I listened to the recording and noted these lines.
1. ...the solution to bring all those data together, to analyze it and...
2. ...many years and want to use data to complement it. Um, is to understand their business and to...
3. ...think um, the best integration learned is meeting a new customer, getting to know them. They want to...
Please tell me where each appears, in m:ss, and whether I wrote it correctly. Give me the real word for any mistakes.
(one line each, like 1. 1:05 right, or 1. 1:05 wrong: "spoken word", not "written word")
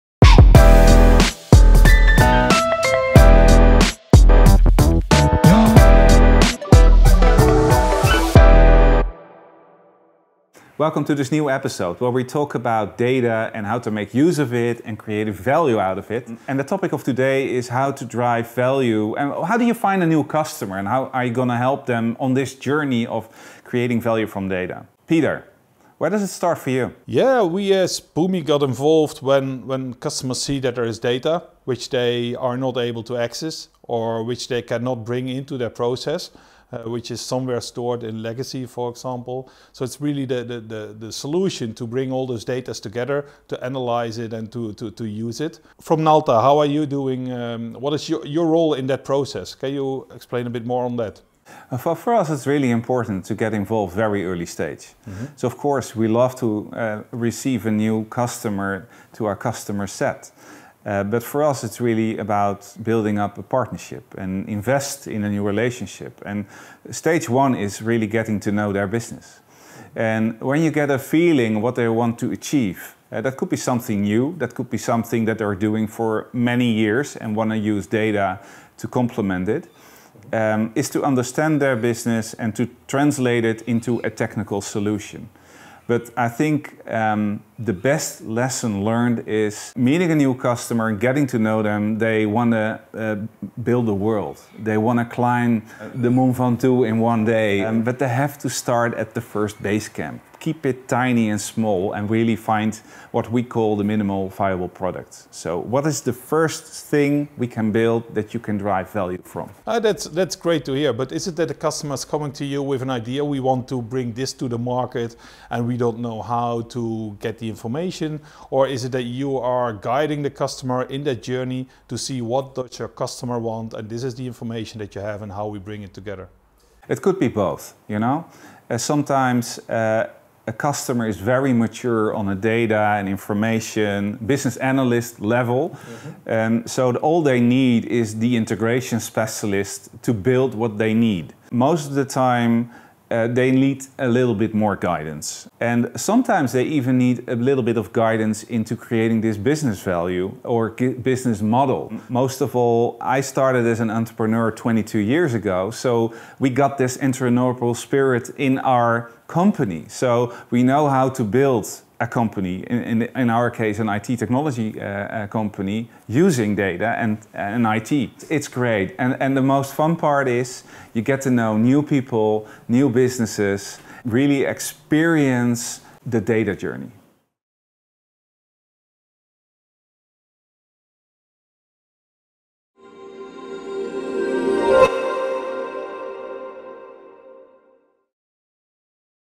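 1. 0:40 right
2. 1:16 right
3. 1:26 wrong: "lesson", not "integration".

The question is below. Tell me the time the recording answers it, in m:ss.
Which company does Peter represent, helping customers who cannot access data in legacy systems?
0:28.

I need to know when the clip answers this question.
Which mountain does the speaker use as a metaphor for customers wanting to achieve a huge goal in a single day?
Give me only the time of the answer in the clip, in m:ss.
1:36.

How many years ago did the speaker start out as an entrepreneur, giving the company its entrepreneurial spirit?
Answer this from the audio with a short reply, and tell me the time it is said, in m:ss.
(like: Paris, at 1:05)
22, at 2:34.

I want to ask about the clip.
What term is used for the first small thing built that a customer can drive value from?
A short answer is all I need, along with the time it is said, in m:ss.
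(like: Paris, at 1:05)
minimal viable product, at 1:43.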